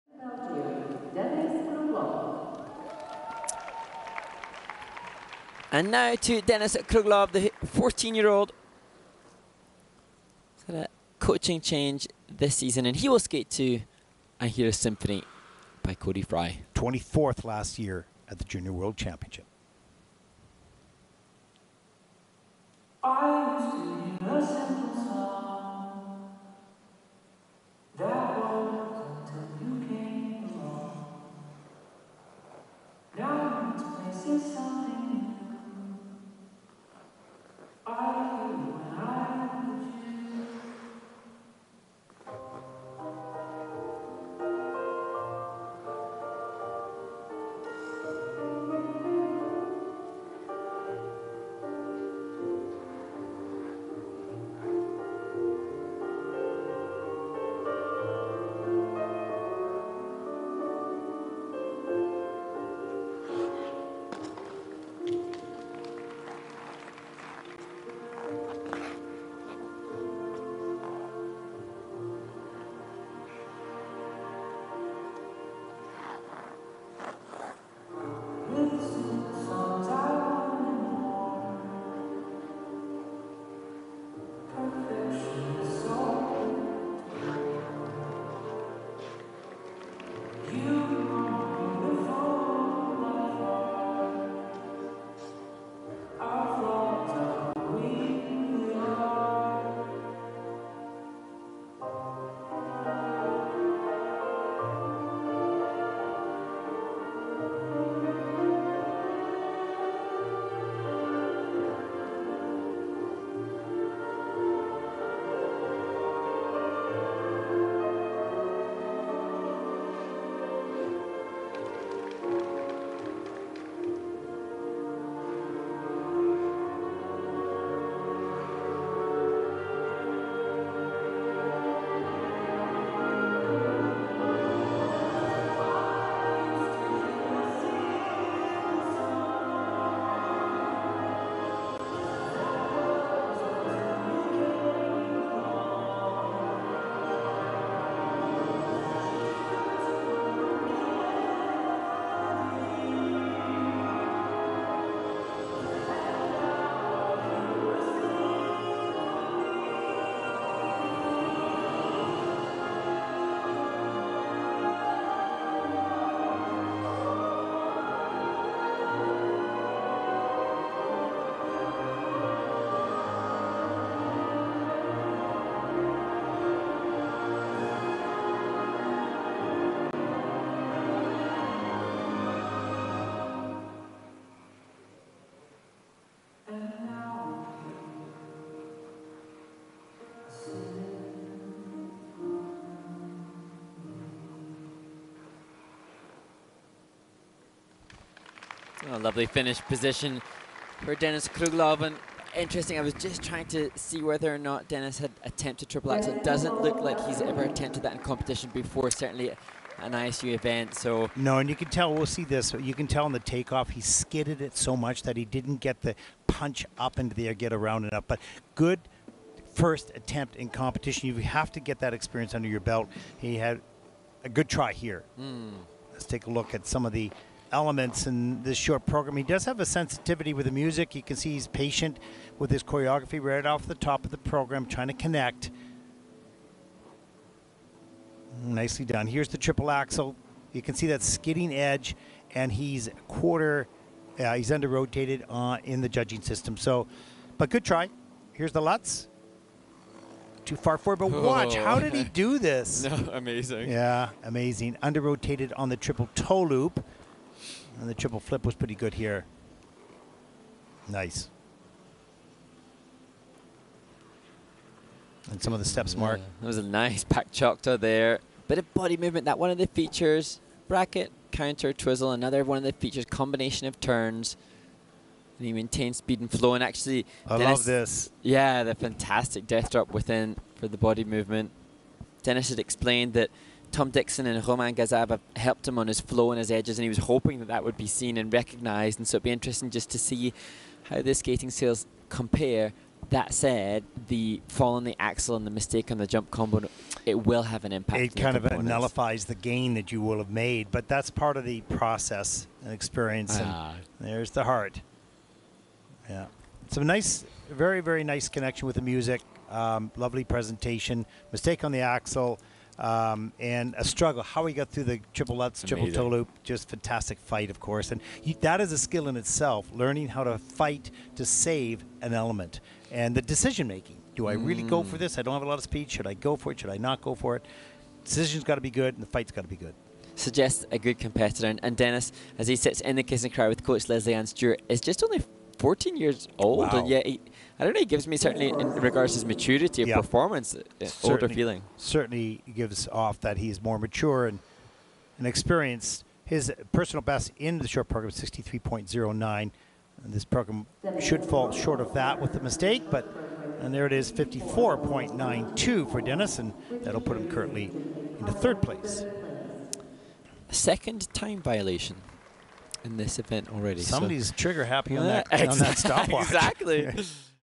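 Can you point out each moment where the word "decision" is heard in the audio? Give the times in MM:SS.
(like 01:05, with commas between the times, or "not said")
05:23, 05:28.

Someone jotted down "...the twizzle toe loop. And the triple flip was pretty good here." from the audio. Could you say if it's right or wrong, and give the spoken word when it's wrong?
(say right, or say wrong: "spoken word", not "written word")
wrong: "triple", not "twizzle".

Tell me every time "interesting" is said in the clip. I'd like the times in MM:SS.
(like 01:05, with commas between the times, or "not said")
03:22, 04:49.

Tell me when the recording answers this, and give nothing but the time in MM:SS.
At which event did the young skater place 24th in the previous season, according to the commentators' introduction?
00:18.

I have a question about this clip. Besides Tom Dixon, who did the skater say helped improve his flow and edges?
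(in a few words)
Roman Gazab.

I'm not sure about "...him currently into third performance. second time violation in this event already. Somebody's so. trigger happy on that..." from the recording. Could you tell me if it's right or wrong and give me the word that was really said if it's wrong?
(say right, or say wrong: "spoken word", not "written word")
wrong: "place", not "performance".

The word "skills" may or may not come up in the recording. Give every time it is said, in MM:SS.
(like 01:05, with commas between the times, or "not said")
04:51, 05:18.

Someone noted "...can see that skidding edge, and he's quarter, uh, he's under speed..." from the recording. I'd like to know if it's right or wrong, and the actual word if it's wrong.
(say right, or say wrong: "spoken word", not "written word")
wrong: "rotated", not "speed".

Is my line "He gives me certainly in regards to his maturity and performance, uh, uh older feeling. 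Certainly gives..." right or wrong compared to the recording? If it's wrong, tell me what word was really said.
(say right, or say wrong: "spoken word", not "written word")
right.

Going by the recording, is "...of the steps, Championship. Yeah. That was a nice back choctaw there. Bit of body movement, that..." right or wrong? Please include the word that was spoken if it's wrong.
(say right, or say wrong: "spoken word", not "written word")
wrong: "Mark", not "Championship".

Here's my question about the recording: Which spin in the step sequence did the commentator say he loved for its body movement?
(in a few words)
Death drop.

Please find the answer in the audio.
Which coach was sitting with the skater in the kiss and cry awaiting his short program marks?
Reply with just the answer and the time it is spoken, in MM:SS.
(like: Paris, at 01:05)
Leslie Ann Stewart, at 05:33.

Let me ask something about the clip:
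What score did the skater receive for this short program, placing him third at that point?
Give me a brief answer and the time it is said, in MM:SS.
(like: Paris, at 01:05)
54.92, at 05:54.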